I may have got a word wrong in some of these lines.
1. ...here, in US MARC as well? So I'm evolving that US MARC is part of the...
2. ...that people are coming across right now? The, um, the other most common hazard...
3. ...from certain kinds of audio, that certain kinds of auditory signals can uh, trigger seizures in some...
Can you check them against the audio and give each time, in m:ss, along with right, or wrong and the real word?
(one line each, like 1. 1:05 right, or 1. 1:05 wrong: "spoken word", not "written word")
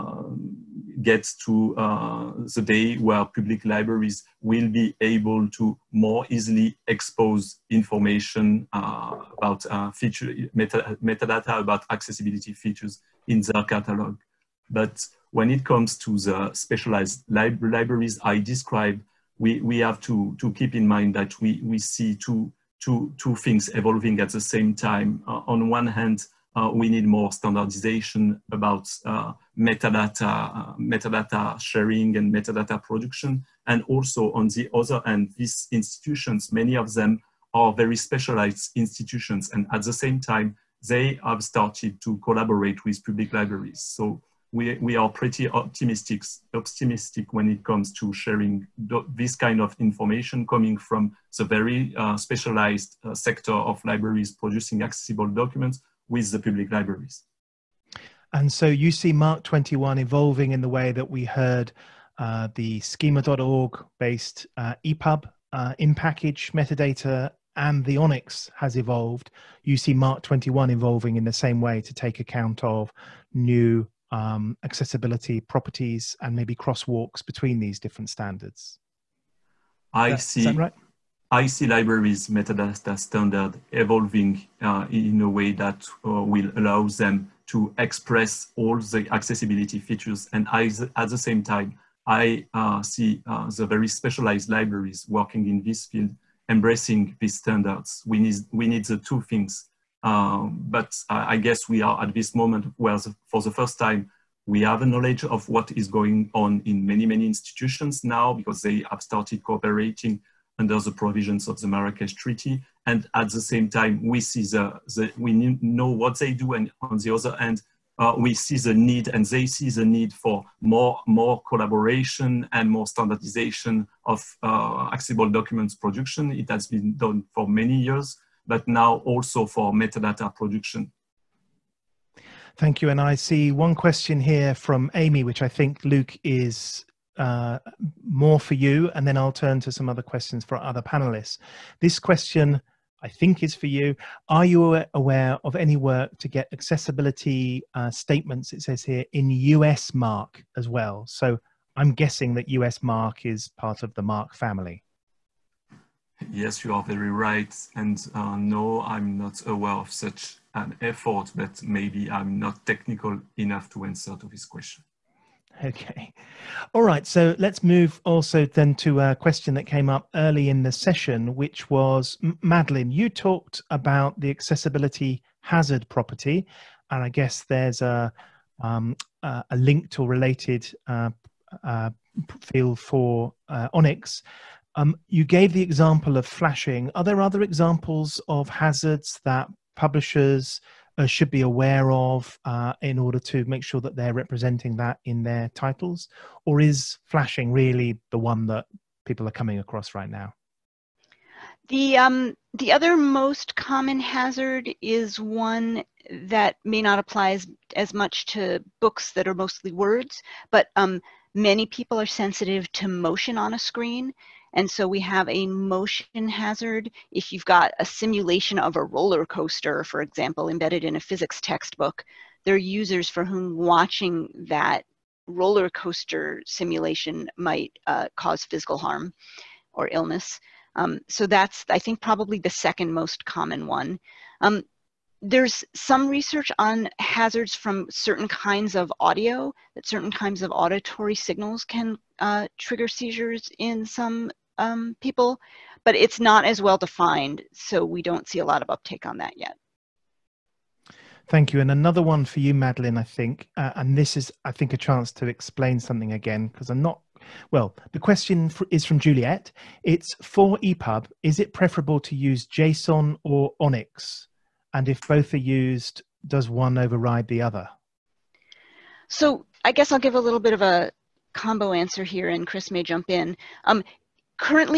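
1. 2:28 wrong: "guessing", not "evolving"
2. 3:18 right
3. 3:57 right.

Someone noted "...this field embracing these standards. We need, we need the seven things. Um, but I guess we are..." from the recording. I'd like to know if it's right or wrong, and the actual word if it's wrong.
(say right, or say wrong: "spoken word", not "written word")
wrong: "two", not "seven".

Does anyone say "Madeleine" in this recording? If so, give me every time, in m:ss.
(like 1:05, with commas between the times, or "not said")
2:52, 4:12.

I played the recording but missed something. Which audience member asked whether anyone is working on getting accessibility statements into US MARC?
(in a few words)
Amy.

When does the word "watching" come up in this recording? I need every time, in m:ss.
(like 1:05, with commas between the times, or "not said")
3:43.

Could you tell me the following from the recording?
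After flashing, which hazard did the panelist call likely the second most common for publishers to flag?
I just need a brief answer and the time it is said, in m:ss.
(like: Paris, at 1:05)
Motion hazard, at 3:35.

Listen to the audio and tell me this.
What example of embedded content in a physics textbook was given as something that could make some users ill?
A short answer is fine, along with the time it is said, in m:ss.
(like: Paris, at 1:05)
Roller coaster simulation, at 3:45.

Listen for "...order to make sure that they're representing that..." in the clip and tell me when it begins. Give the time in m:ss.
3:12.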